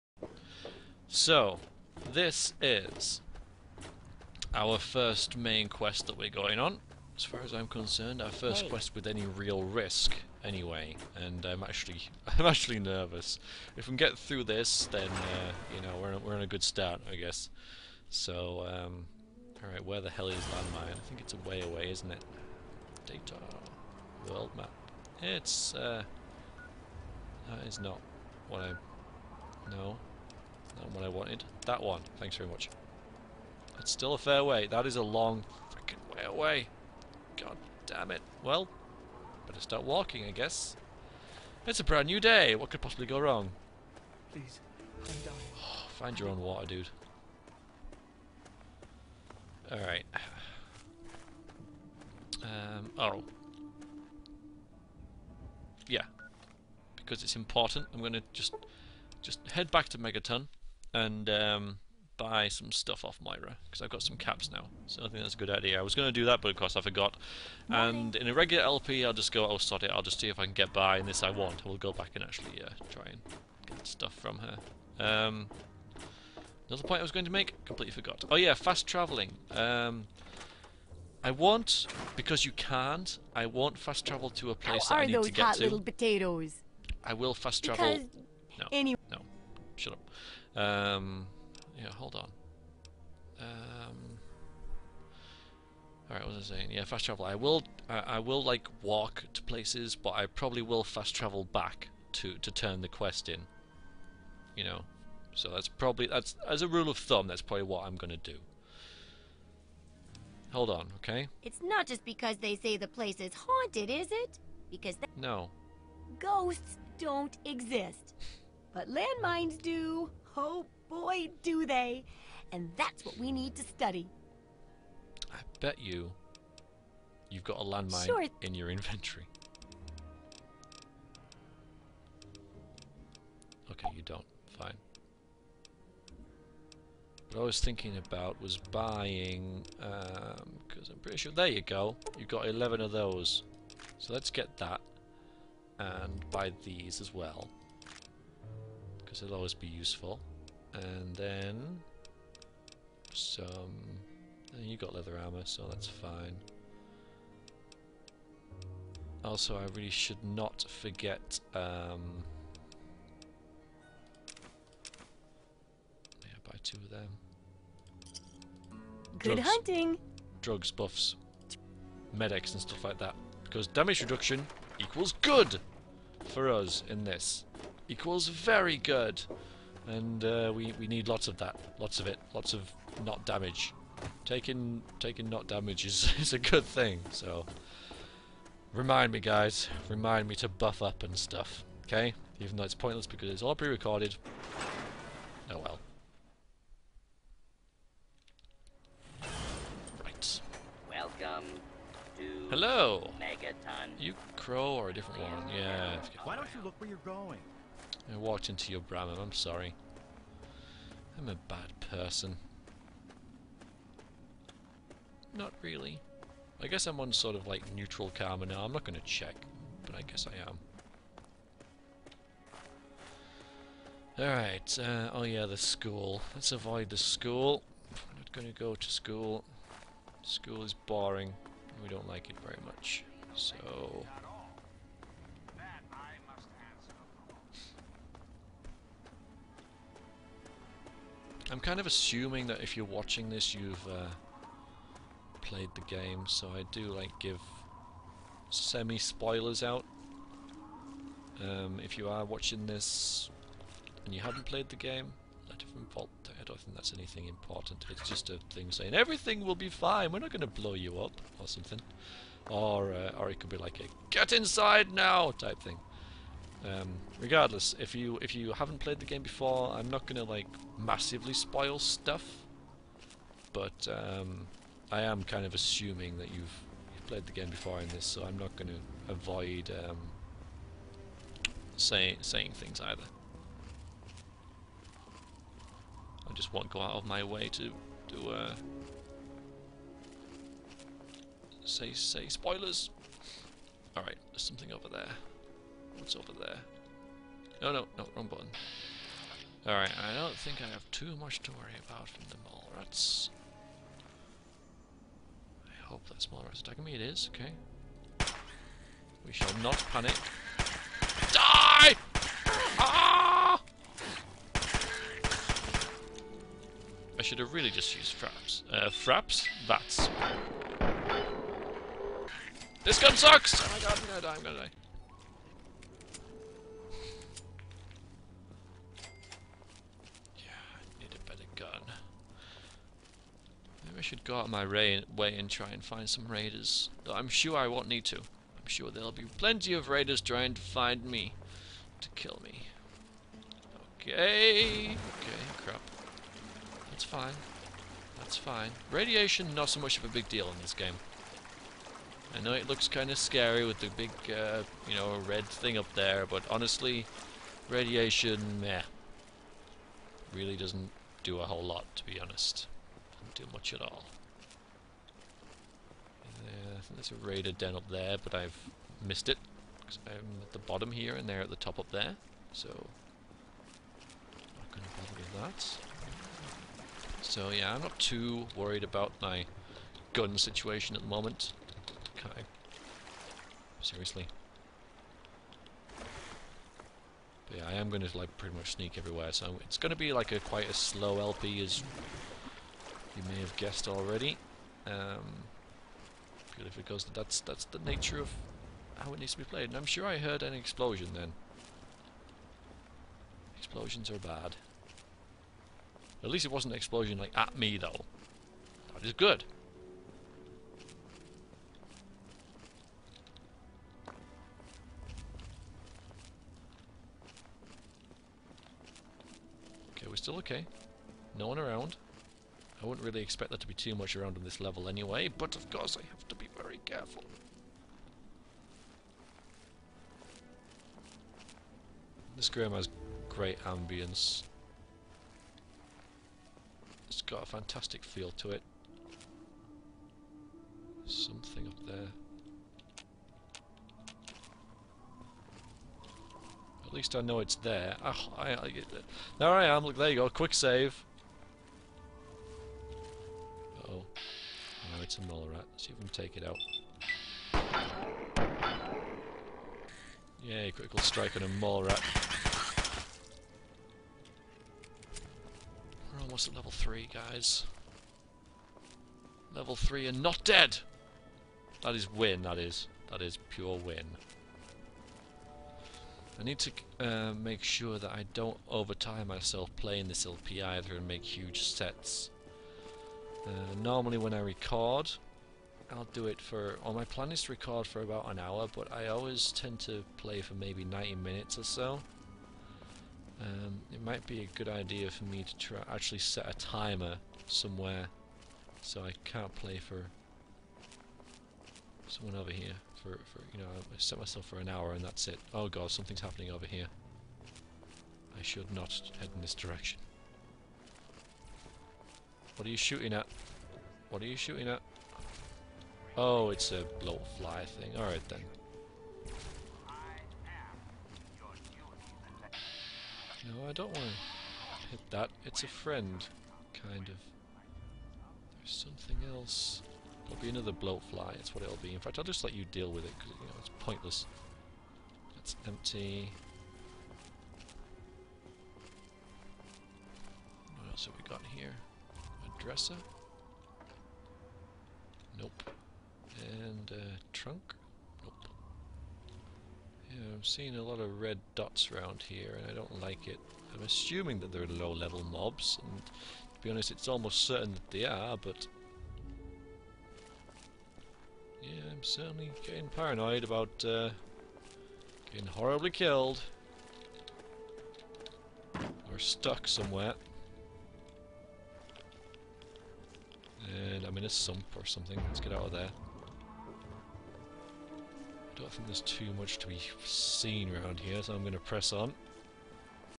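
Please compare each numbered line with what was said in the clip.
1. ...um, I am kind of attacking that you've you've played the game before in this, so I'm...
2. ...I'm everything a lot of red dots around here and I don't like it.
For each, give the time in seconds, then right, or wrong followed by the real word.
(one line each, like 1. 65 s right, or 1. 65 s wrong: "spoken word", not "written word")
1. 273 s wrong: "assuming", not "attacking"
2. 550 s wrong: "seeing", not "everything".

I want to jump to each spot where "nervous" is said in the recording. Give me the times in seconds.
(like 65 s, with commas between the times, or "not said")
12 s.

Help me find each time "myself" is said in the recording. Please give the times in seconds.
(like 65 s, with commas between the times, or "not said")
479 s, 504 s.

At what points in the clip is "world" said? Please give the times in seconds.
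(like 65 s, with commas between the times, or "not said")
24 s.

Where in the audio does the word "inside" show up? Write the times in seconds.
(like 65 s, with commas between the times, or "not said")
264 s.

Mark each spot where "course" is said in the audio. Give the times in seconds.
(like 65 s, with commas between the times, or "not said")
66 s, 425 s.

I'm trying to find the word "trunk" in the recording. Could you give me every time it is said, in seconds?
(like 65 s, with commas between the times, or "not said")
547 s.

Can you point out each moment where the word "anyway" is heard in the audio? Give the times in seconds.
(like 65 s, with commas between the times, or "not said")
10 s, 88 s, 424 s.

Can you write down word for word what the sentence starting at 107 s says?
That's probably what I'm gonna do.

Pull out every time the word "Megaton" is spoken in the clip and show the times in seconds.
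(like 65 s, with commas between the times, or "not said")
59 s, 203 s.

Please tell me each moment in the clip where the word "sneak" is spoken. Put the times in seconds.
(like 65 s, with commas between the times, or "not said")
388 s.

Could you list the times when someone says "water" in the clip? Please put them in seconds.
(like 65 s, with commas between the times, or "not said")
46 s.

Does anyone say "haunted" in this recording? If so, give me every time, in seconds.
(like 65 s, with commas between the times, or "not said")
113 s.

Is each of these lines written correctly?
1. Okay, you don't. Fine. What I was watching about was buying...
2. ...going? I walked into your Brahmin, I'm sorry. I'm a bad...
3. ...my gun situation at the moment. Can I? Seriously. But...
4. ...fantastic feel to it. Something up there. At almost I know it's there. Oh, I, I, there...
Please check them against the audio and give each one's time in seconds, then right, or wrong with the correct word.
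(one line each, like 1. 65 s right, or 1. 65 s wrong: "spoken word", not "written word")
1. 133 s wrong: "thinking", not "watching"
2. 207 s right
3. 379 s right
4. 437 s wrong: "least", not "almost".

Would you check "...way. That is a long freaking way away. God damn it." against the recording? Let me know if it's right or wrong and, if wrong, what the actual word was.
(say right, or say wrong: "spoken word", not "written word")
right.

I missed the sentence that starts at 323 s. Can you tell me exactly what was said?
Oh my god, I'm gonna die, I'm gonna die.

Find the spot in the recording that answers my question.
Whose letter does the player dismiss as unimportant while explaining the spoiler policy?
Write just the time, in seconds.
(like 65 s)
255 s.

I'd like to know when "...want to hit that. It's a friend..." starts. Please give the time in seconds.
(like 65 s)
523 s.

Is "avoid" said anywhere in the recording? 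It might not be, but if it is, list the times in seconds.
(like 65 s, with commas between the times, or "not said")
226 s, 279 s.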